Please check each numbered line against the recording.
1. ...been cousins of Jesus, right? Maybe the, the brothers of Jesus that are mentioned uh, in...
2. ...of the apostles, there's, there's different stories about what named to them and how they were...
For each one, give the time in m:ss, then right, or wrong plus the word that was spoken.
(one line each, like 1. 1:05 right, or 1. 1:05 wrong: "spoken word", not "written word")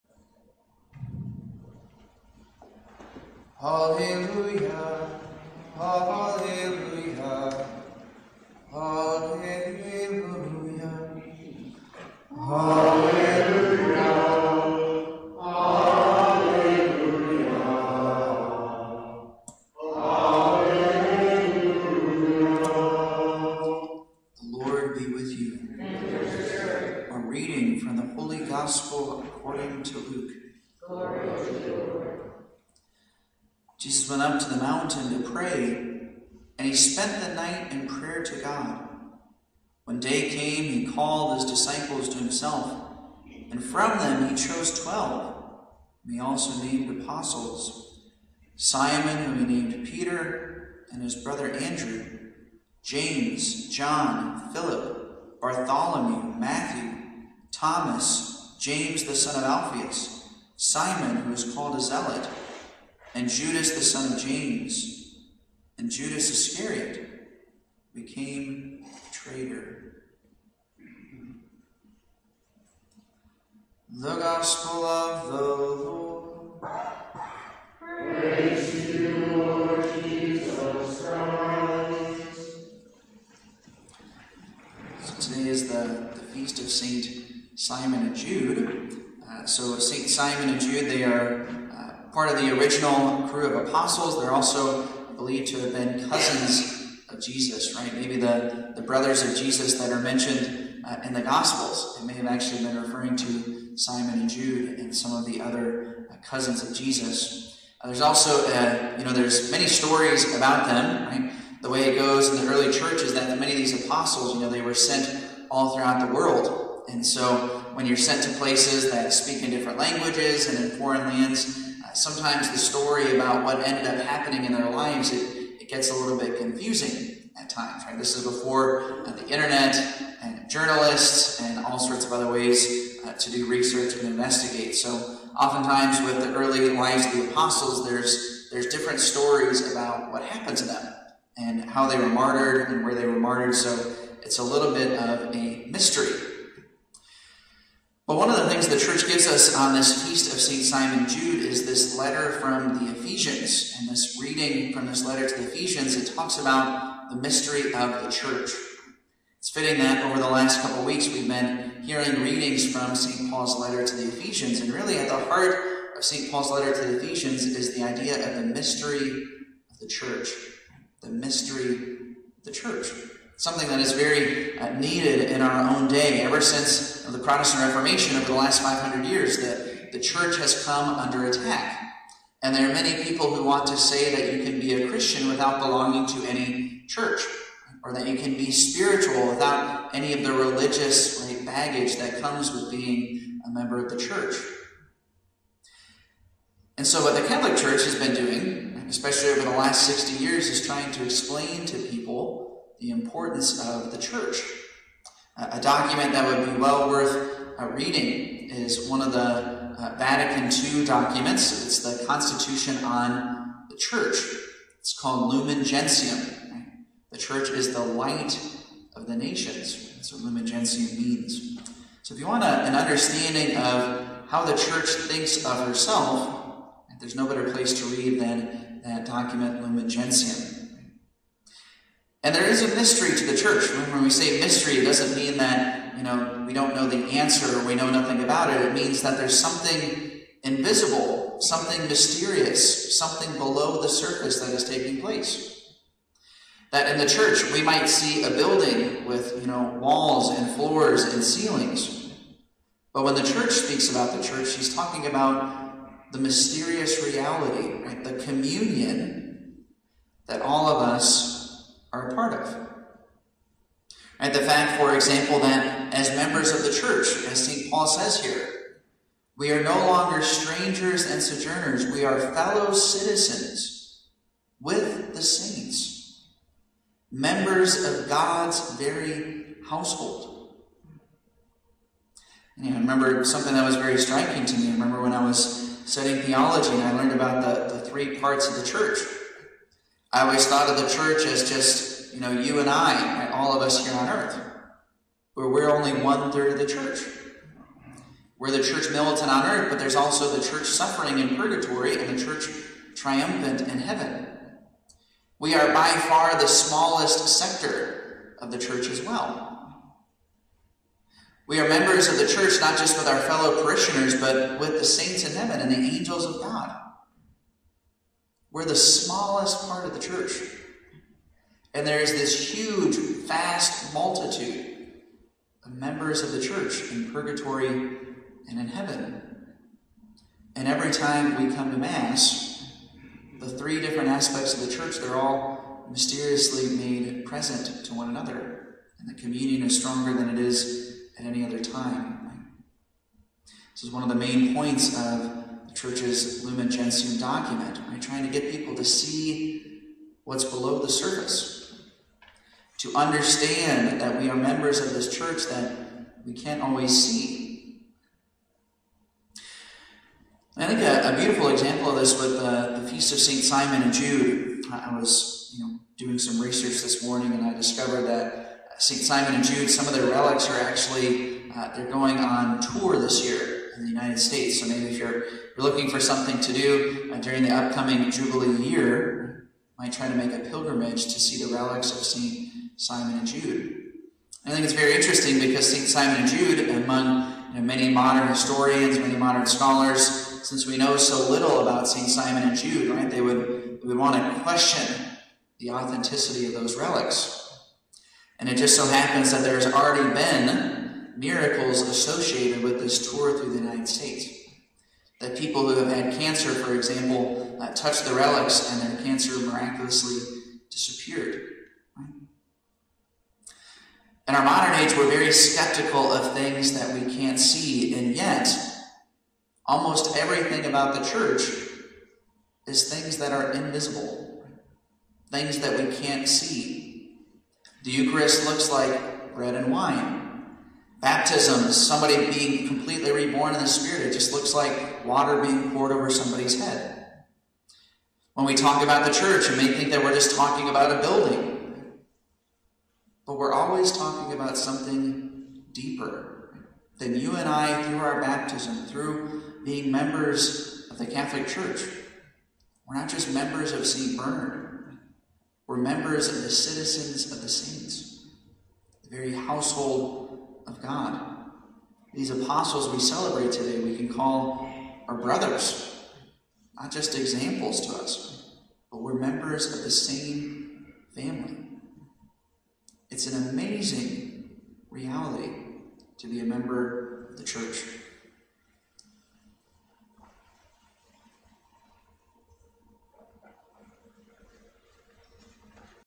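1. 1:35 right
2. 2:17 wrong: "happened", not "named".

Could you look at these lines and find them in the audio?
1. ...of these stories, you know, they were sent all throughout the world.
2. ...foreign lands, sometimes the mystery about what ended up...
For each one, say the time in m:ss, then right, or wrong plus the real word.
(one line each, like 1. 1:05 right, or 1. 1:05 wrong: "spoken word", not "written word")
1. 1:53 wrong: "apostles", not "stories"
2. 2:00 wrong: "story", not "mystery".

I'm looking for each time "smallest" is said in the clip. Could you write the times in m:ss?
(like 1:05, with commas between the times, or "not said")
5:06, 5:18.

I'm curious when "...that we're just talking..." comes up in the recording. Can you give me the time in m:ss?
7:19.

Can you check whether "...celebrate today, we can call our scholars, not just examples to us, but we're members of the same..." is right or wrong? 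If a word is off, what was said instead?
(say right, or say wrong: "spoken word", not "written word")
wrong: "brothers", not "scholars".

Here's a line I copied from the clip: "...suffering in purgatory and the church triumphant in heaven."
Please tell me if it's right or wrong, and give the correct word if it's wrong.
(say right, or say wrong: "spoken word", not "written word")
right.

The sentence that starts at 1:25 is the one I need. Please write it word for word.
So today is the, the feast of Saint Simon and Jude.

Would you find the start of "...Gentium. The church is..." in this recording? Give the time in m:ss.
3:35.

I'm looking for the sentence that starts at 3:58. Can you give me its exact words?
It means that there's something invisible, something mysterious, something below the surface that is taking place.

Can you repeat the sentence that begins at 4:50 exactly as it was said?
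I always thought of the church as just, you know, you and I, right?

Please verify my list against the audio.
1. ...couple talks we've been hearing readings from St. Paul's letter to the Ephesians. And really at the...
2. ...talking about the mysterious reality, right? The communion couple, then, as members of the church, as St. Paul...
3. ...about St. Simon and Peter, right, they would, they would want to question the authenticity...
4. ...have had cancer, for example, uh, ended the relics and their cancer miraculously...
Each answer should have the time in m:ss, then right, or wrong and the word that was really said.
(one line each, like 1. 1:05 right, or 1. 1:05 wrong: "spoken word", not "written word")
1. 2:40 wrong: "weeks", not "talks"
2. 4:14 wrong: "example", not "couple"
3. 6:31 wrong: "Jude", not "Peter"
4. 6:45 wrong: "touched", not "ended".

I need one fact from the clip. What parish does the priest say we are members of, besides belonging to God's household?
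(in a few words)
St. Bernard.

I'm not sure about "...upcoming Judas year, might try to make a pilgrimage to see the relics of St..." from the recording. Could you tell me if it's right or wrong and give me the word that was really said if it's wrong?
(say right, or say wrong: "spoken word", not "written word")
wrong: "Jubilee", not "Judas".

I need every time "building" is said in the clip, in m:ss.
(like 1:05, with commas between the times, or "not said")
4:08, 7:21.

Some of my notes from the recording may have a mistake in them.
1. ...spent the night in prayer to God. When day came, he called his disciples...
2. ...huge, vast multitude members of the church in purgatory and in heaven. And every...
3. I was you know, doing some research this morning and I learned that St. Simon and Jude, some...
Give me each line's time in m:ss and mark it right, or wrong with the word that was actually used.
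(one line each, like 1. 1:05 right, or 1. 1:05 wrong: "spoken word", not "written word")
1. 0:36 right
2. 5:22 right
3. 6:04 wrong: "discovered", not "learned".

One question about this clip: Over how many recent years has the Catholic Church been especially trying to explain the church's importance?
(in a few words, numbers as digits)
60.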